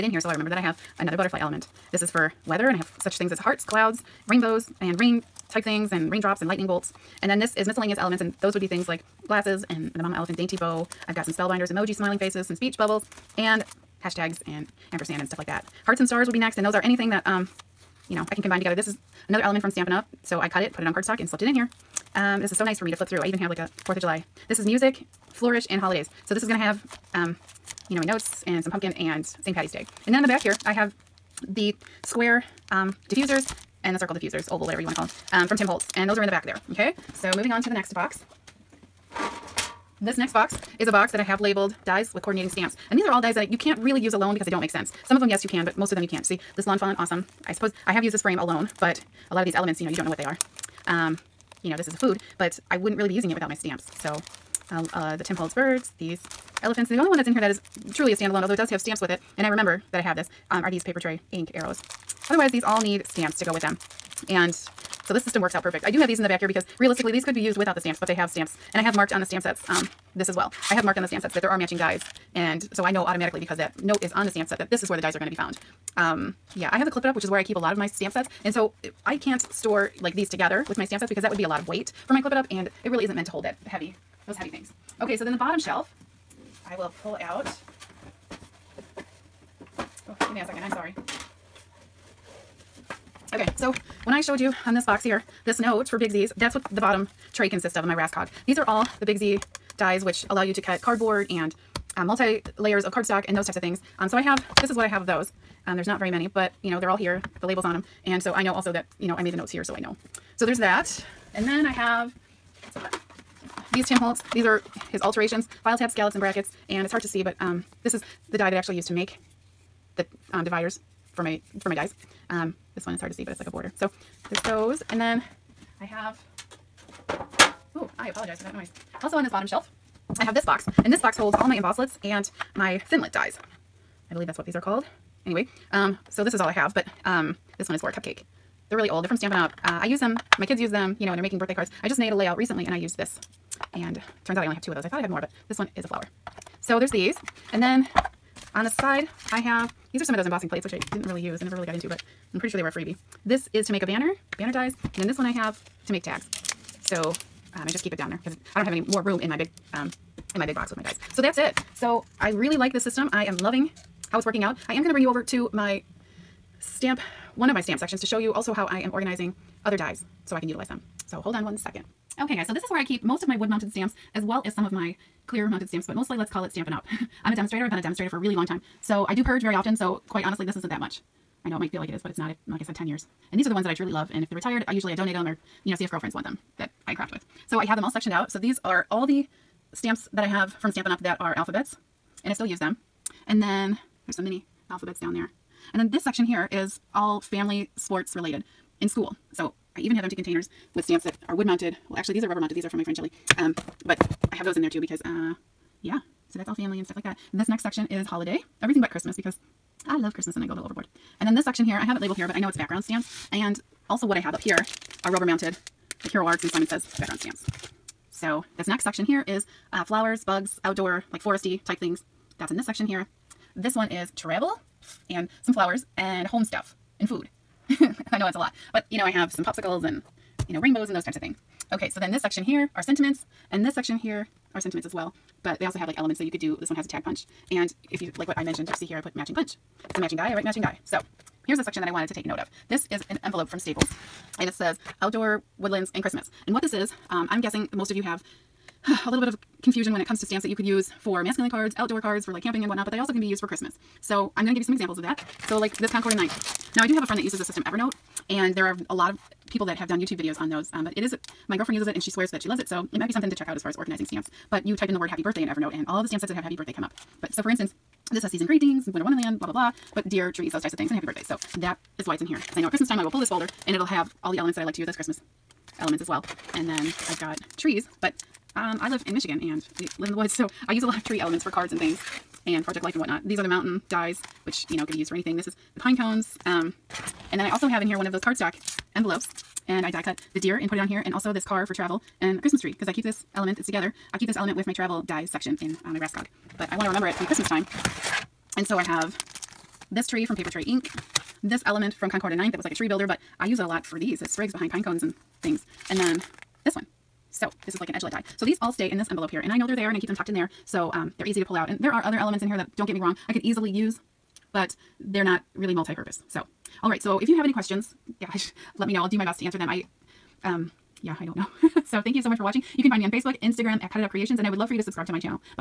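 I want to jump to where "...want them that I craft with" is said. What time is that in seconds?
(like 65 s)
186 s.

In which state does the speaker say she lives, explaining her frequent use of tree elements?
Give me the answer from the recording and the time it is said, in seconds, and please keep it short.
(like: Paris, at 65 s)
Michigan, at 279 s.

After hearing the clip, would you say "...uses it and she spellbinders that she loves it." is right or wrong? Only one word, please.
wrong.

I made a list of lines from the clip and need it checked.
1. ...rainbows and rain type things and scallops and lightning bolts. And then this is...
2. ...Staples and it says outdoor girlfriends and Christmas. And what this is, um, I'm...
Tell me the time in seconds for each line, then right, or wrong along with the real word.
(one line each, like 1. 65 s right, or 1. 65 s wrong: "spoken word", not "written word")
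1. 4 s wrong: "raindrops", not "scallops"
2. 243 s wrong: "woodlands", not "girlfriends".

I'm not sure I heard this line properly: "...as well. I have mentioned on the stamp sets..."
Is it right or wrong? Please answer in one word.
wrong.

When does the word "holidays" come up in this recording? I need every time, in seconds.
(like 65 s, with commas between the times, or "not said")
25 s, 208 s.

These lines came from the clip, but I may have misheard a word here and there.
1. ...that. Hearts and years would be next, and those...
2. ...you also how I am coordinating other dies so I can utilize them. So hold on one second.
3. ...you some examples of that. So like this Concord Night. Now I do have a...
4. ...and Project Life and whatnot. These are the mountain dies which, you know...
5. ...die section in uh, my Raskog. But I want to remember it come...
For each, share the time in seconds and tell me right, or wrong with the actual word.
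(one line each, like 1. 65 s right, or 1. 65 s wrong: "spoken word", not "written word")
1. 15 s wrong: "stars", not "years"
2. 168 s wrong: "organizing", not "coordinating"
3. 254 s right
4. 282 s right
5. 295 s right.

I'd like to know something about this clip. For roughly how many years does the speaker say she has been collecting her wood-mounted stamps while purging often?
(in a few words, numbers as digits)
10.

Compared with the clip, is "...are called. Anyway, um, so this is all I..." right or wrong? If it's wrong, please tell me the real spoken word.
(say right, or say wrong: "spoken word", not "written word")
right.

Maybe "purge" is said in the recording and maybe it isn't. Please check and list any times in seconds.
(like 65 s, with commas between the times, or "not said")
179 s.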